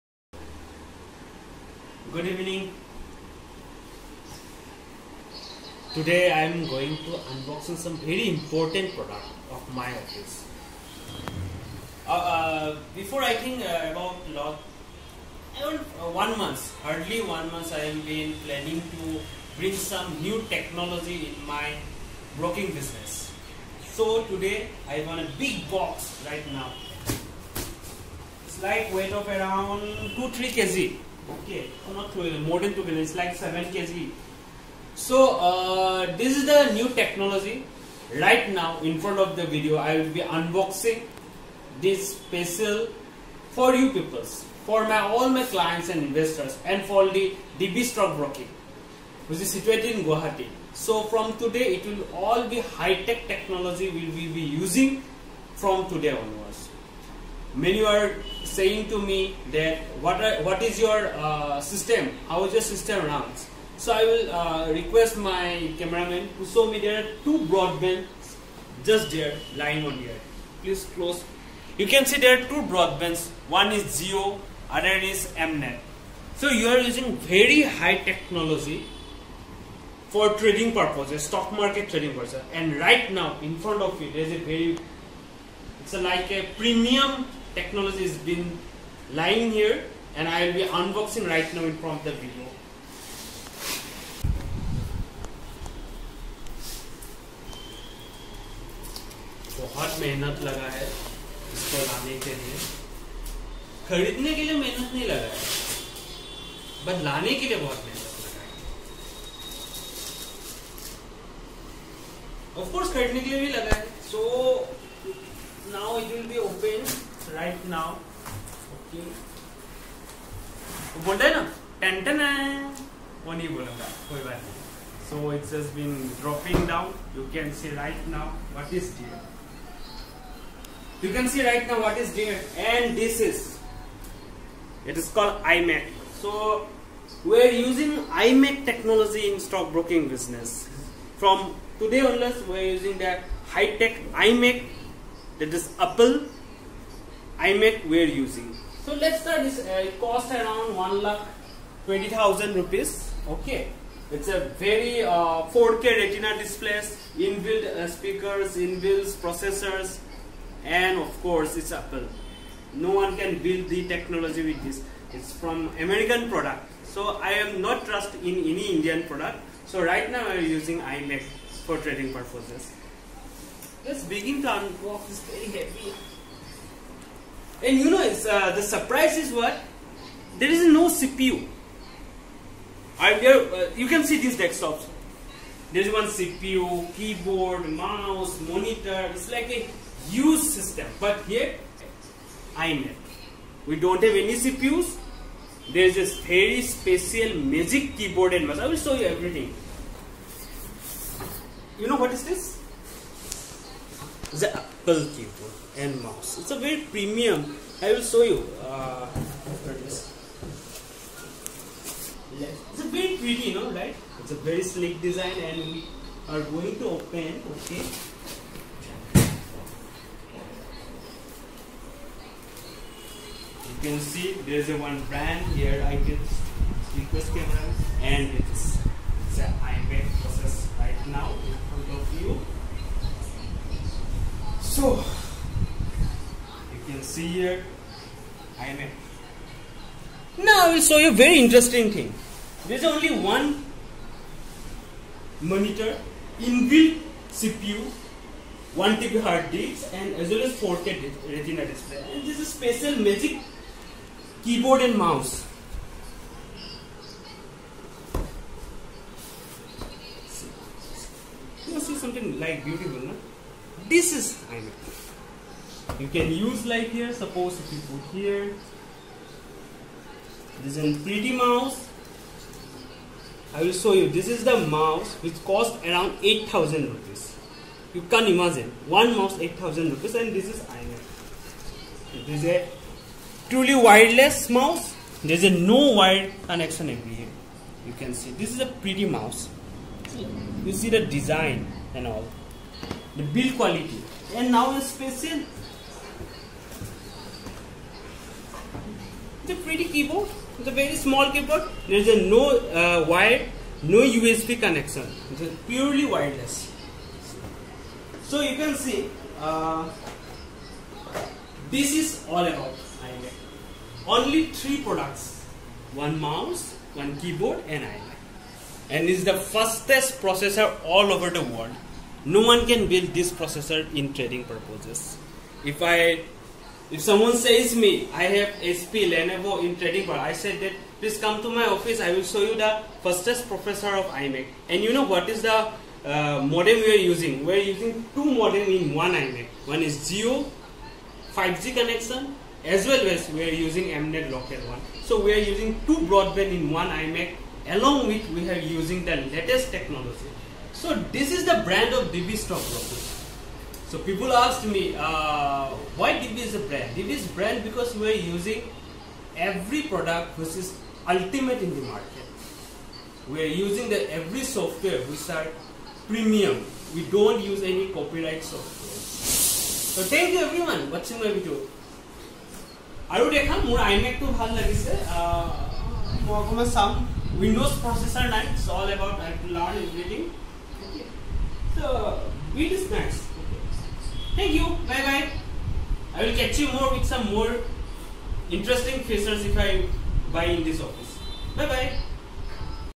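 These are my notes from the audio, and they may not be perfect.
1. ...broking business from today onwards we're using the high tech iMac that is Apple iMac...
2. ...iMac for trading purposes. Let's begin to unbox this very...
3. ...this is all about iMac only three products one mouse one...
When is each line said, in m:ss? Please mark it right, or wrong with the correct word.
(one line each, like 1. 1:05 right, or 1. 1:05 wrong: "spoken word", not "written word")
1. 2:19 right
2. 2:50 right
3. 5:11 right.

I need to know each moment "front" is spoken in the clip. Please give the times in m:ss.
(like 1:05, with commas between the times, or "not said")
0:38, 1:23, 1:31, 3:51.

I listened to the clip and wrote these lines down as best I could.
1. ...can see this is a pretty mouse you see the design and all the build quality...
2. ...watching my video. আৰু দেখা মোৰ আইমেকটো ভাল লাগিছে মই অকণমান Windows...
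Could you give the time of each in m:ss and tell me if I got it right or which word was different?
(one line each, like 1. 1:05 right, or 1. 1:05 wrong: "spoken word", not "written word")
1. 4:47 right
2. 6:10 right.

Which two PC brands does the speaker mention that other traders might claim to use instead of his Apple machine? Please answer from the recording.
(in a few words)
HP, Lenovo.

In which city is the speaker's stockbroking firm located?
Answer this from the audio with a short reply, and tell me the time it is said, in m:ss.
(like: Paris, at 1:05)
Guwahati, at 0:50.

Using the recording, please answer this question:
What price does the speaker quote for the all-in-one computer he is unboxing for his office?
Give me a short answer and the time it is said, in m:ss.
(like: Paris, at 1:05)
1 lakh 20,000 rupees, at 2:30.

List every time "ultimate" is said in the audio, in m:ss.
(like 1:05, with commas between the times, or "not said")
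6:01.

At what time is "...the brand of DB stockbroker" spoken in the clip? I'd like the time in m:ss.
5:51.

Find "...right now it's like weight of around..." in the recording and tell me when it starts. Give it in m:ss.
0:26.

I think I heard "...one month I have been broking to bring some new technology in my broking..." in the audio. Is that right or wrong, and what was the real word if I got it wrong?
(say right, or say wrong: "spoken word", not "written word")
wrong: "planning", not "broking".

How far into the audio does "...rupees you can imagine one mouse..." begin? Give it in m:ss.
4:36.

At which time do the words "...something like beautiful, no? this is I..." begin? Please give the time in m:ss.
4:21.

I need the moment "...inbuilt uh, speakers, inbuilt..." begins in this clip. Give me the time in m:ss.
2:37.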